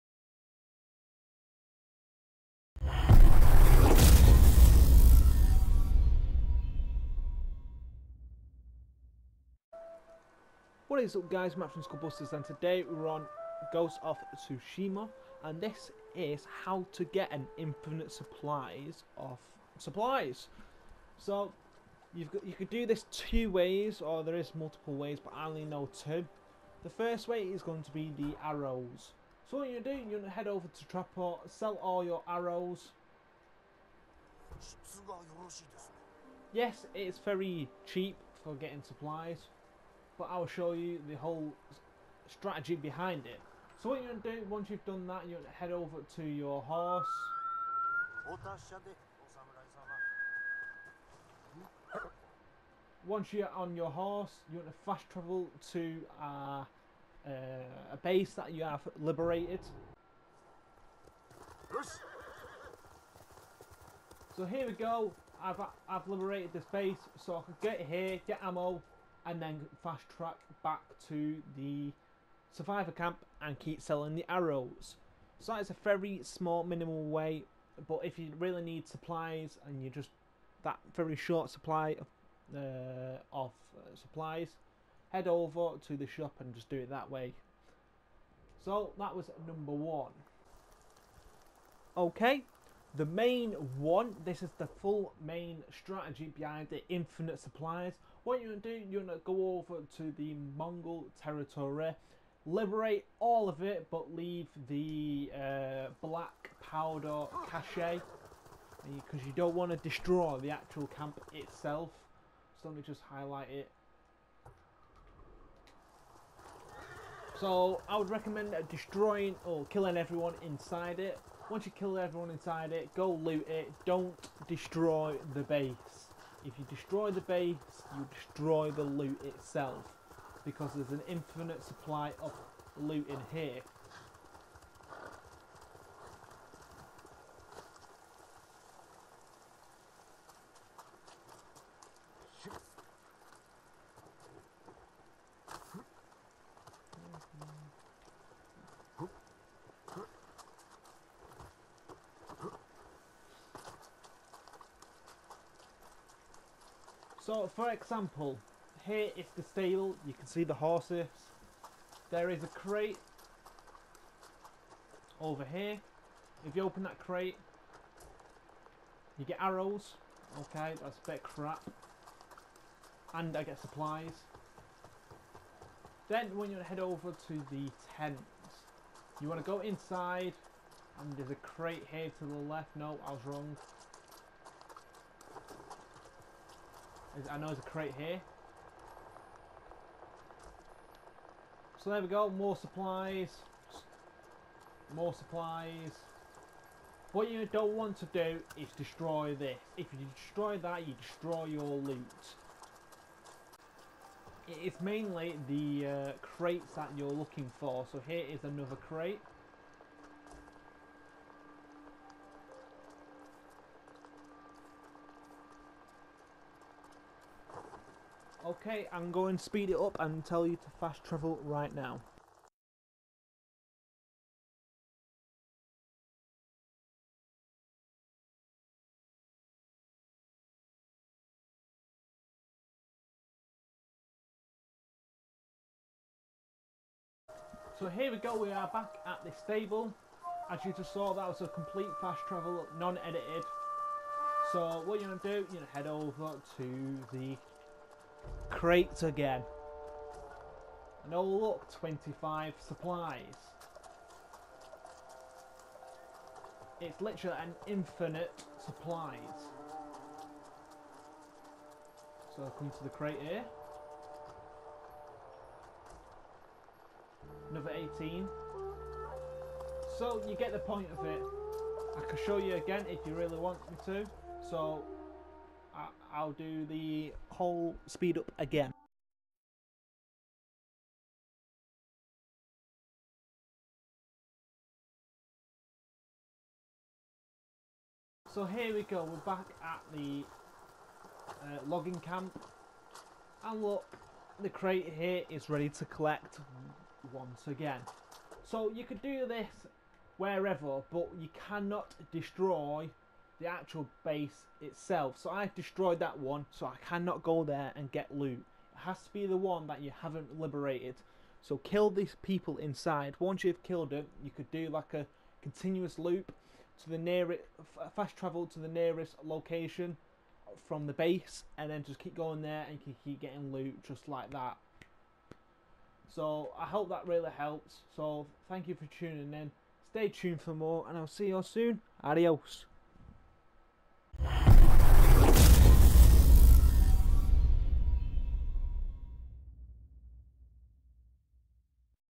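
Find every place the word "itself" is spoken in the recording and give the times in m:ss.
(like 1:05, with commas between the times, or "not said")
1:51, 2:09, 5:04.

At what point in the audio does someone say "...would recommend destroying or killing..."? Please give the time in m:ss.
1:57.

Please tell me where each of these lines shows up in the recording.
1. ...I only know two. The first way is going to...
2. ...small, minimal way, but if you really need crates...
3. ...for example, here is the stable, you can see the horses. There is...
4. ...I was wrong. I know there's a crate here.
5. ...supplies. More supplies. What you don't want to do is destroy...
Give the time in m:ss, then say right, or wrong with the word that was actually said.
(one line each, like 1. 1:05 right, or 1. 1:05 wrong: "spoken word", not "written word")
1. 0:25 right
2. 1:16 wrong: "supplies", not "crates"
3. 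2:37 right
4. 3:03 right
5. 3:12 right.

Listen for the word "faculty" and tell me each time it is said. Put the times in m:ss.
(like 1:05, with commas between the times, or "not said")
not said.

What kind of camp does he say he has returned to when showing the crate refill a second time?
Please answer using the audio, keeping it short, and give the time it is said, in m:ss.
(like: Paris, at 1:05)
Logging camp, at 4:51.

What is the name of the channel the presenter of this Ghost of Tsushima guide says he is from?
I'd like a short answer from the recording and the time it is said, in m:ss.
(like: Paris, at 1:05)
Skullbusters, at 0:11.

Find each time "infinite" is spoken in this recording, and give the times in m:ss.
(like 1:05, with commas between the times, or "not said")
0:17, 1:36, 2:11, 4:17.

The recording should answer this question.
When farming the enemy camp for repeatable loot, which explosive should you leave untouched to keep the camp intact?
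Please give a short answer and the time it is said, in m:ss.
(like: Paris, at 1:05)
Black powder cache, at 1:46.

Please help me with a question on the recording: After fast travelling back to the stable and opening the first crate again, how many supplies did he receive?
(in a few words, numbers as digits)
25.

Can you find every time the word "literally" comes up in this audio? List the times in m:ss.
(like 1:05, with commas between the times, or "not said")
4:17.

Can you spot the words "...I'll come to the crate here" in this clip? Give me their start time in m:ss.
4:22.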